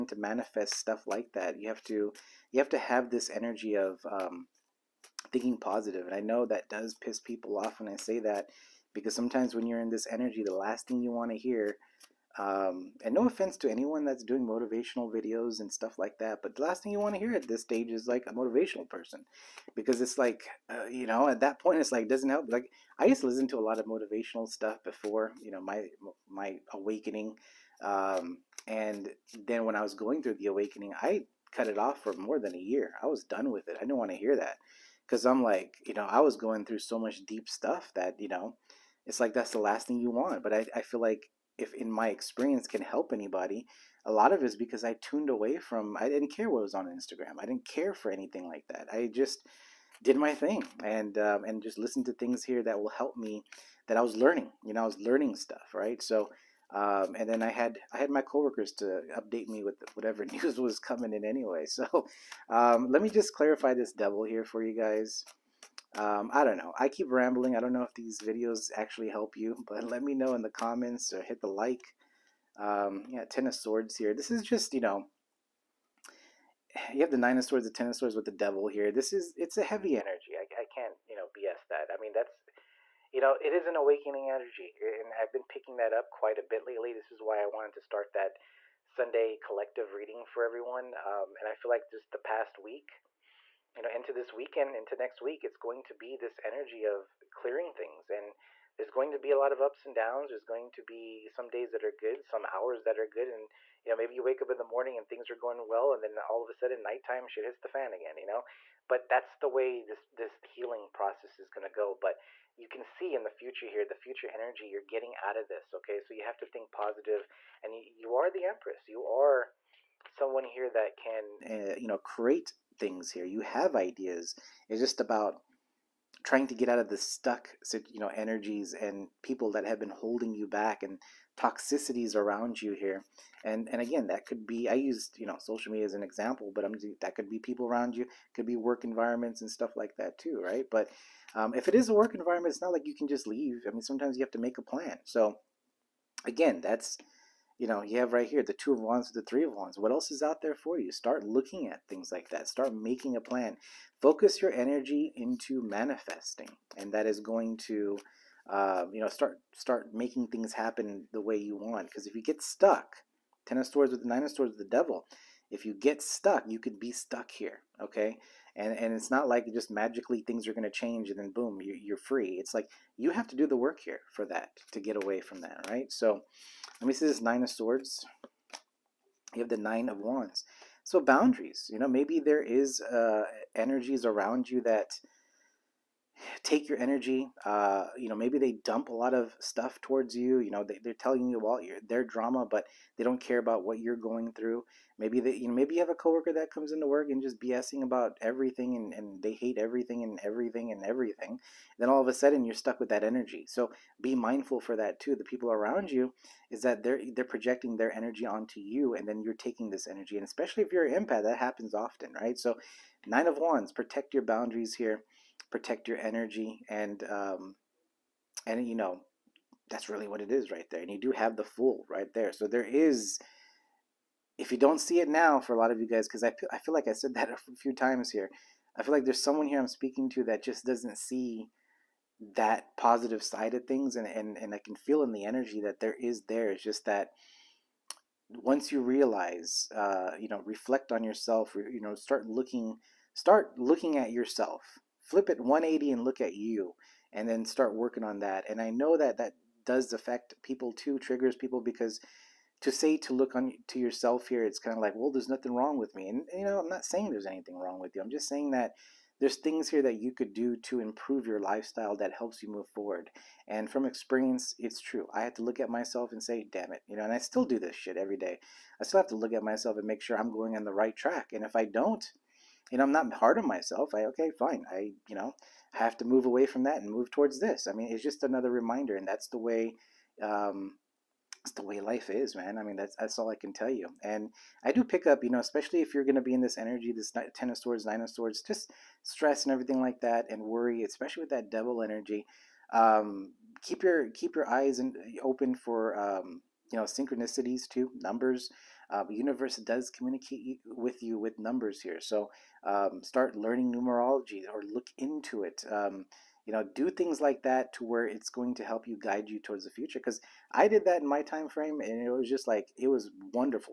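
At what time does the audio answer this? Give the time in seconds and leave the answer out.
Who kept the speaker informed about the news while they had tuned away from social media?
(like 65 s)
58 s.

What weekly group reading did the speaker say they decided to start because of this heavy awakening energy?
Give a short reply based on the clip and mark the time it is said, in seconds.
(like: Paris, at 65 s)
Sunday collective reading, at 88 s.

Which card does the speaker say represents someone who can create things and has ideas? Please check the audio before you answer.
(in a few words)
The Empress.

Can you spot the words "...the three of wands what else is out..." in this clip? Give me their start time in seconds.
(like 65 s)
149 s.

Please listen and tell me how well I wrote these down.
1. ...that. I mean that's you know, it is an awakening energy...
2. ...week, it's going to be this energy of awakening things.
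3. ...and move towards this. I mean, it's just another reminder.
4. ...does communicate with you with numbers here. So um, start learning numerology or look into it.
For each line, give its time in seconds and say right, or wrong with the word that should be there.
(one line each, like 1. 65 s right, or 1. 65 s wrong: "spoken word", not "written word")
1. 81 s right
2. 95 s wrong: "clearing", not "awakening"
3. 276 s right
4. 299 s right.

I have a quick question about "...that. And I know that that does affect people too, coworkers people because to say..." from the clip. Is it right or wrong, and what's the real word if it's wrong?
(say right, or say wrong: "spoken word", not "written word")
wrong: "triggers", not "coworkers".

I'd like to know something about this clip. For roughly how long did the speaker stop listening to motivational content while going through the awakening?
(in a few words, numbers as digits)
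more than a year.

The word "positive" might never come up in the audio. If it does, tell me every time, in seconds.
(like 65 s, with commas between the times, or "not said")
5 s, 116 s, 232 s.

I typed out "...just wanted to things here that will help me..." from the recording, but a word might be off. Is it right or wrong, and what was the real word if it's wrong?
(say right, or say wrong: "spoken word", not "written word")
wrong: "listened", not "wanted".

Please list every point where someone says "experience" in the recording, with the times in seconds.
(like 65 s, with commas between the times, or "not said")
42 s, 263 s.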